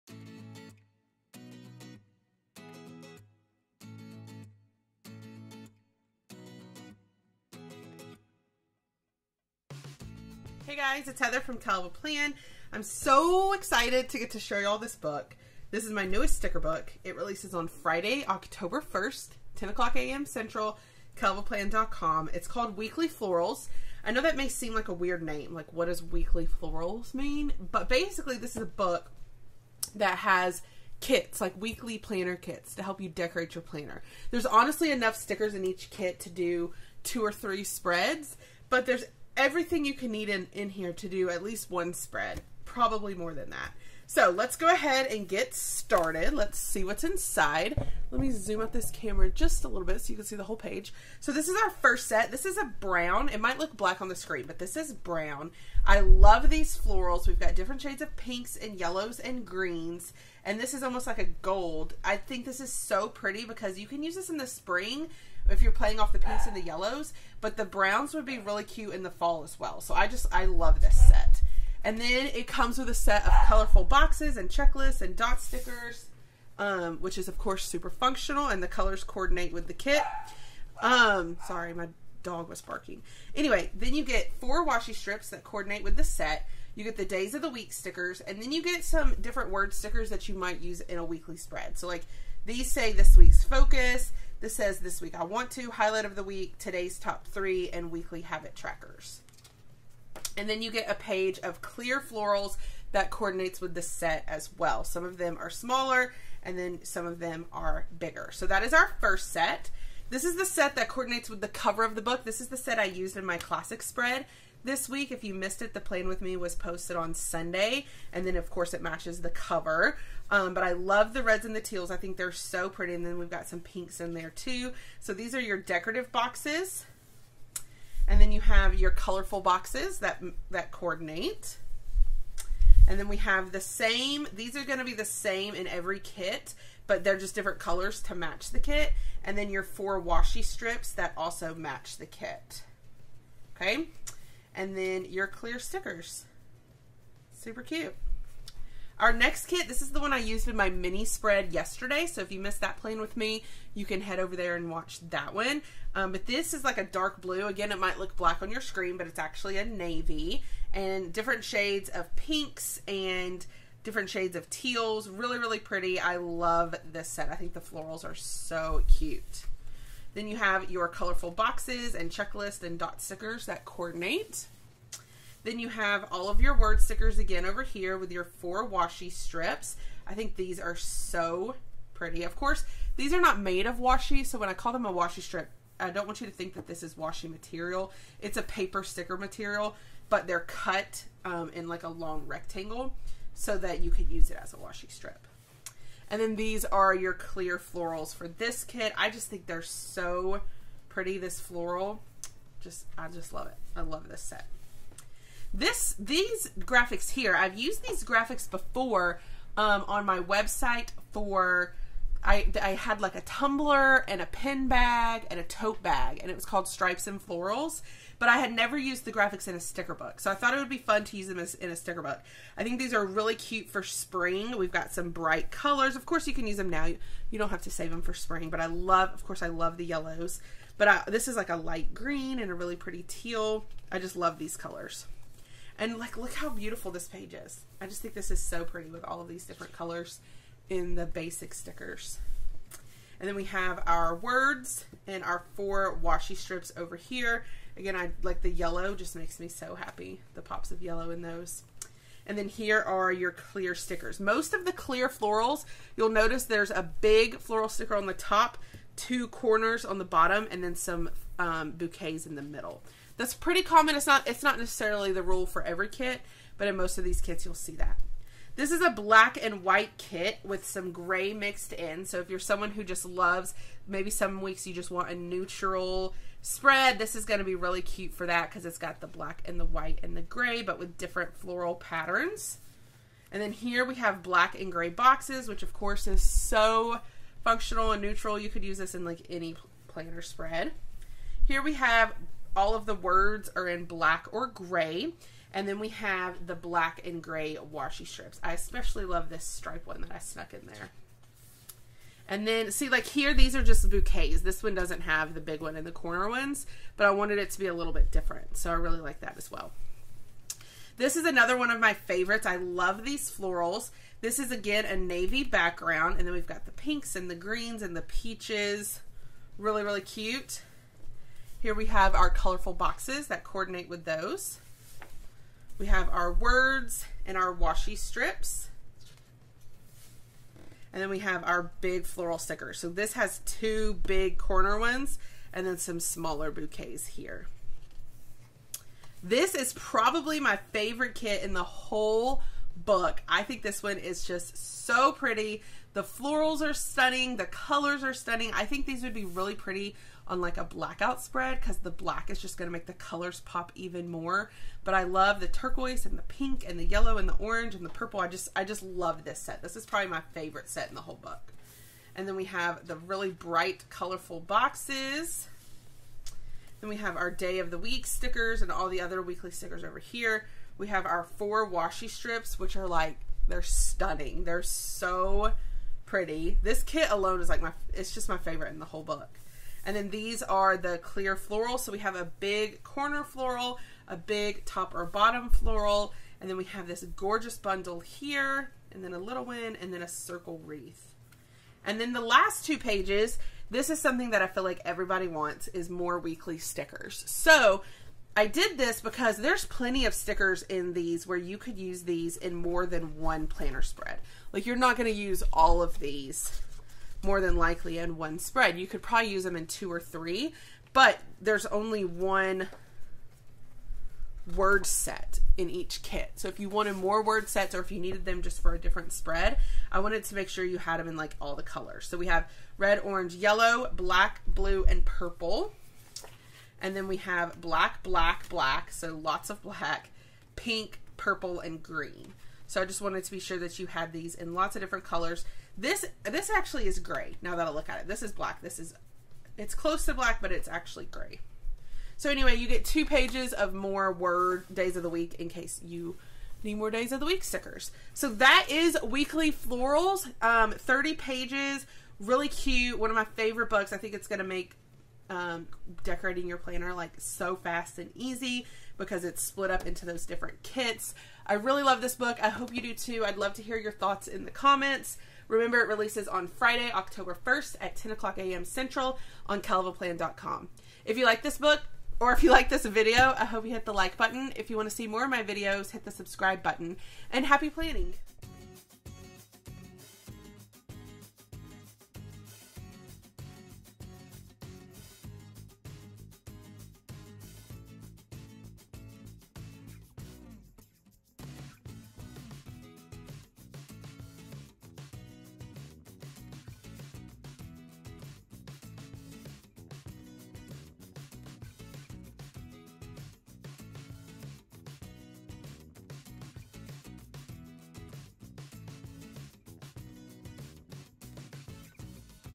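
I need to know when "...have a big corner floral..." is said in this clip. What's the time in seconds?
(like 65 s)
381 s.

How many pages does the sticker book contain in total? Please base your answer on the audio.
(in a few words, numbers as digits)
30.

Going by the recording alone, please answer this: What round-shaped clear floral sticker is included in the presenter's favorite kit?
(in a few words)
Circle wreath.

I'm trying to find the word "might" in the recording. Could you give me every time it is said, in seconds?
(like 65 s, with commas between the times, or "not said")
53 s, 90 s, 157 s.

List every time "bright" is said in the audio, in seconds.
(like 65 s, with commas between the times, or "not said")
225 s, 363 s.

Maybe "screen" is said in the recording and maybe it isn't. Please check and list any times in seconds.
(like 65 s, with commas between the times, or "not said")
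54 s, 158 s.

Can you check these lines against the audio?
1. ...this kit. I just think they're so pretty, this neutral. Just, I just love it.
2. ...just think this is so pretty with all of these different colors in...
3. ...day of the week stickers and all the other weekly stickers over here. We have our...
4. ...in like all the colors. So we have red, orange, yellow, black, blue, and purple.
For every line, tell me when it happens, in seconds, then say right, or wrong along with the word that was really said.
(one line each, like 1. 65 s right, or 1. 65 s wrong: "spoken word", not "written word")
1. 198 s wrong: "floral", not "neutral"
2. 237 s right
3. 367 s right
4. 421 s right.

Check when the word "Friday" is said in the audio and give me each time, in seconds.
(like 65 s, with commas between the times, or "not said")
17 s, 466 s.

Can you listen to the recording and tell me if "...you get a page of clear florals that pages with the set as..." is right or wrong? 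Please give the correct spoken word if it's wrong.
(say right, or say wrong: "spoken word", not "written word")
wrong: "coordinates", not "pages".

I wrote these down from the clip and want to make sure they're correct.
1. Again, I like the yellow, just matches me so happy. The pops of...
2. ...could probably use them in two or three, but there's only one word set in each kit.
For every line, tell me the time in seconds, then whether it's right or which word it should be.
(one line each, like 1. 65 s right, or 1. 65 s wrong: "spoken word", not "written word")
1. 247 s wrong: "makes", not "matches"
2. 408 s right.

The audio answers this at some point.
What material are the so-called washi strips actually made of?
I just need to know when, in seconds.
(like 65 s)
188 s.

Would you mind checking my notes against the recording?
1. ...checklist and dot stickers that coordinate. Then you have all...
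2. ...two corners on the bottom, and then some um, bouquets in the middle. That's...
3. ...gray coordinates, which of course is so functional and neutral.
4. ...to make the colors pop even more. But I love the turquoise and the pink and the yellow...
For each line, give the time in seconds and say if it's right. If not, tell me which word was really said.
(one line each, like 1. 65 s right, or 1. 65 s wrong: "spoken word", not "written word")
1. 172 s right
2. 258 s right
3. 284 s wrong: "boxes", not "coordinates"
4. 352 s right.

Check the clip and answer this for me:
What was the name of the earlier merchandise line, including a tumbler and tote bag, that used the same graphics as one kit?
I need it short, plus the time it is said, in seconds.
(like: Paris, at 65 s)
Stripes and Florals, at 216 s.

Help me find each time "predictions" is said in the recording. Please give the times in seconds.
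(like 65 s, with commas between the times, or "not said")
not said.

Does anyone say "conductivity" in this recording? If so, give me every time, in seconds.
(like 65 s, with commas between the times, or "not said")
not said.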